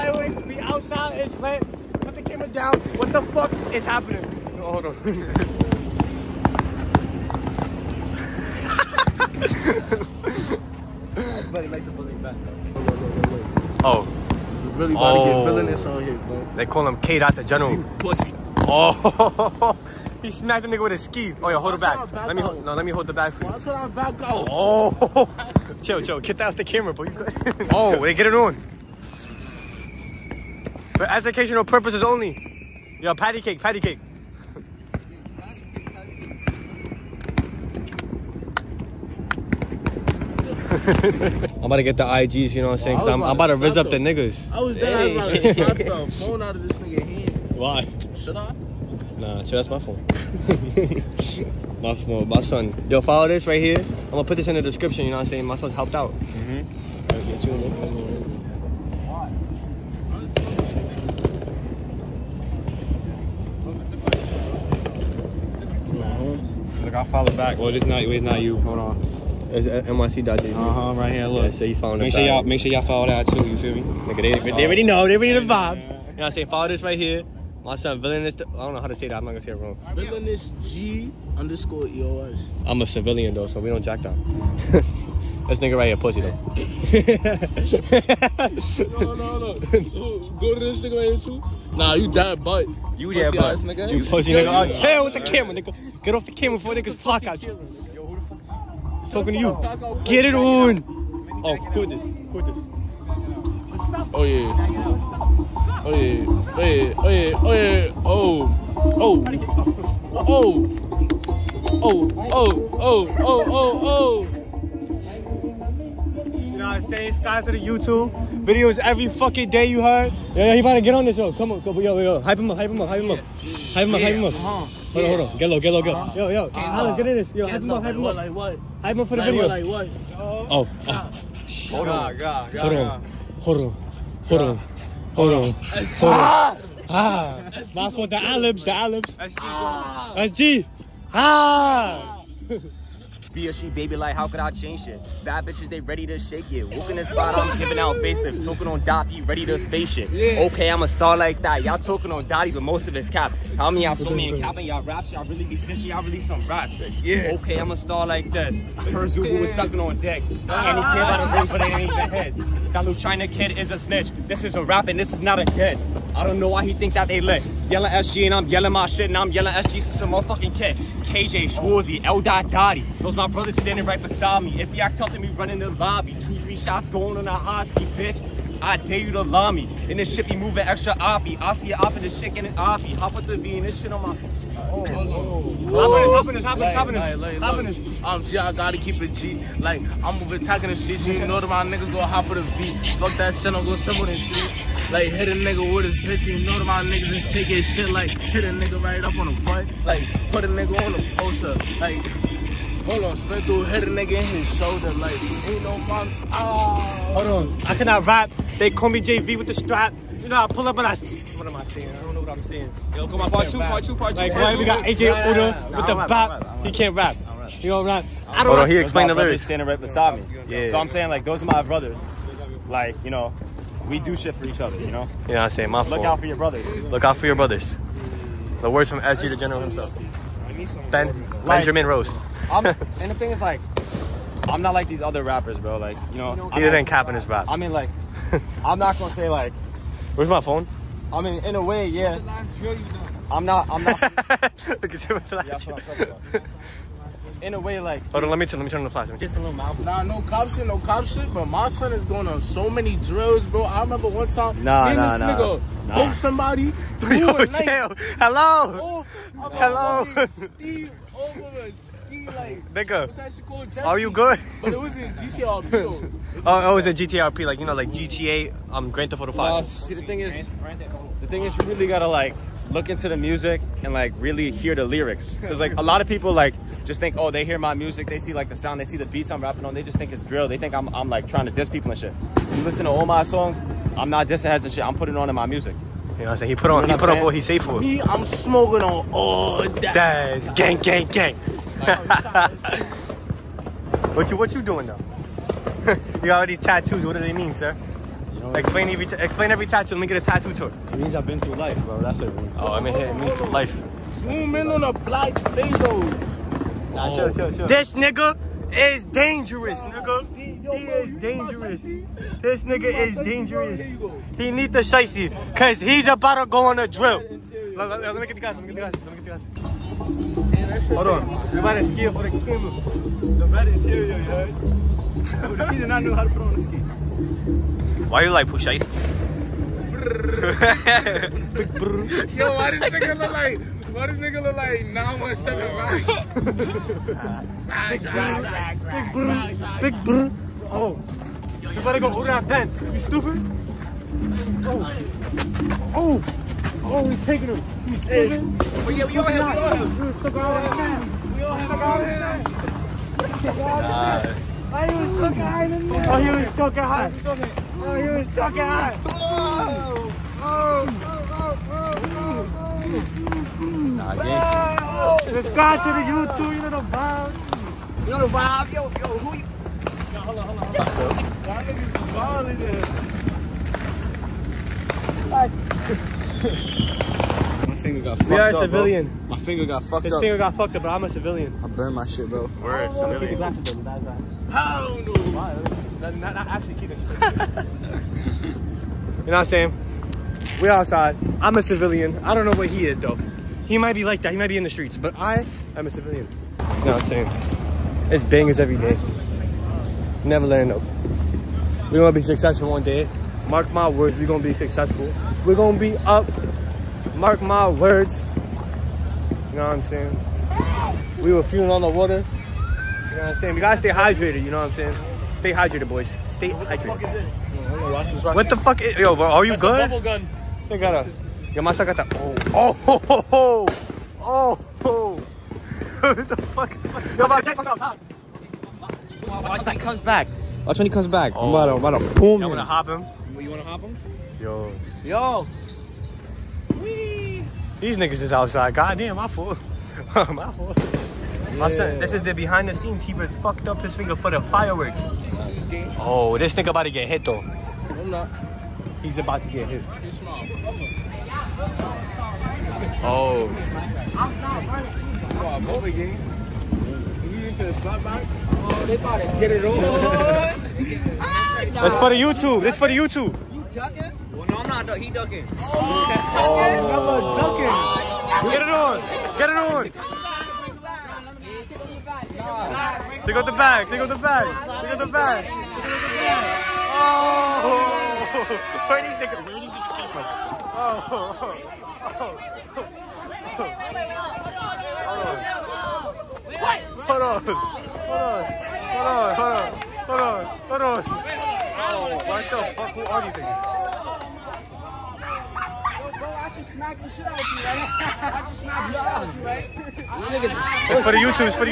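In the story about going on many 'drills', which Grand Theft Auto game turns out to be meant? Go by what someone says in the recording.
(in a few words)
Grand Theft Auto Five.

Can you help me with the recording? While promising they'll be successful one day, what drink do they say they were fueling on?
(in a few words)
Water.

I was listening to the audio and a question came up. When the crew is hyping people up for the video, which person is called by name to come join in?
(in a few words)
Alex.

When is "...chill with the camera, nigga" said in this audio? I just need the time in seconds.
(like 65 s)
94 s.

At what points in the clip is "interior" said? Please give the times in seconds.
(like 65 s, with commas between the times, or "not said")
323 s.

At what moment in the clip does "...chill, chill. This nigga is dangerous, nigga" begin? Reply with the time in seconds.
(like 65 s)
307 s.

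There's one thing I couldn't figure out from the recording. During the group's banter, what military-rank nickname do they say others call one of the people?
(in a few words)
K. Dot the General.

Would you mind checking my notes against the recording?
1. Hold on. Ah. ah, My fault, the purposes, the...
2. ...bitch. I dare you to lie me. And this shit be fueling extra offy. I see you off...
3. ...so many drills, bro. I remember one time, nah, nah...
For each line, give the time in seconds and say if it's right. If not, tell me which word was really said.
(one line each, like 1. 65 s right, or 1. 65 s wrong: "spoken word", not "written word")
1. 135 s wrong: "olives", not "purposes"
2. 177 s wrong: "moving", not "fueling"
3. 252 s right.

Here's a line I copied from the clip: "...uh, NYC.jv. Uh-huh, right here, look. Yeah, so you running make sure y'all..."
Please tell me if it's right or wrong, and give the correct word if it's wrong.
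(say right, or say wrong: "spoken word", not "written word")
wrong: "following", not "running".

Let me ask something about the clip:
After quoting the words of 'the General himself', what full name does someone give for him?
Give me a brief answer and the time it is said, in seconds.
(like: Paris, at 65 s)
Benjamin Rose, at 231 s.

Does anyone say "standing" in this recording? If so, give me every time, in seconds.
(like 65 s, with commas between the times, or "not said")
173 s, 219 s.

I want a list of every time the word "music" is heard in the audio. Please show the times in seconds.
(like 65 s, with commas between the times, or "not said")
273 s, 277 s, 285 s.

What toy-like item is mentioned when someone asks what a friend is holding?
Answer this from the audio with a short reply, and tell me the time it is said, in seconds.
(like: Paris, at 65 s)
Bubble gun, at 419 s.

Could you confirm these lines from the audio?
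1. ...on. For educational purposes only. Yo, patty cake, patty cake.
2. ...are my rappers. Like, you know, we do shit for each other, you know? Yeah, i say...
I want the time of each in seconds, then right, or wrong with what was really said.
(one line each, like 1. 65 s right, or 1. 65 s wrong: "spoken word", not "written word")
1. 28 s right
2. 221 s wrong: "brothers", not "rappers".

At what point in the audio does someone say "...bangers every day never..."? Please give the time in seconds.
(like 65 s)
398 s.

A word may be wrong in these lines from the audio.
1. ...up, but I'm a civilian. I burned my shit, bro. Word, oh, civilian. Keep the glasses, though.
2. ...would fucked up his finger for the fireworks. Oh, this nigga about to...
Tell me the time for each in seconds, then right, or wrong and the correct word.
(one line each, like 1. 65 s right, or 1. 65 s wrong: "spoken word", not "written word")
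1. 380 s right
2. 443 s right.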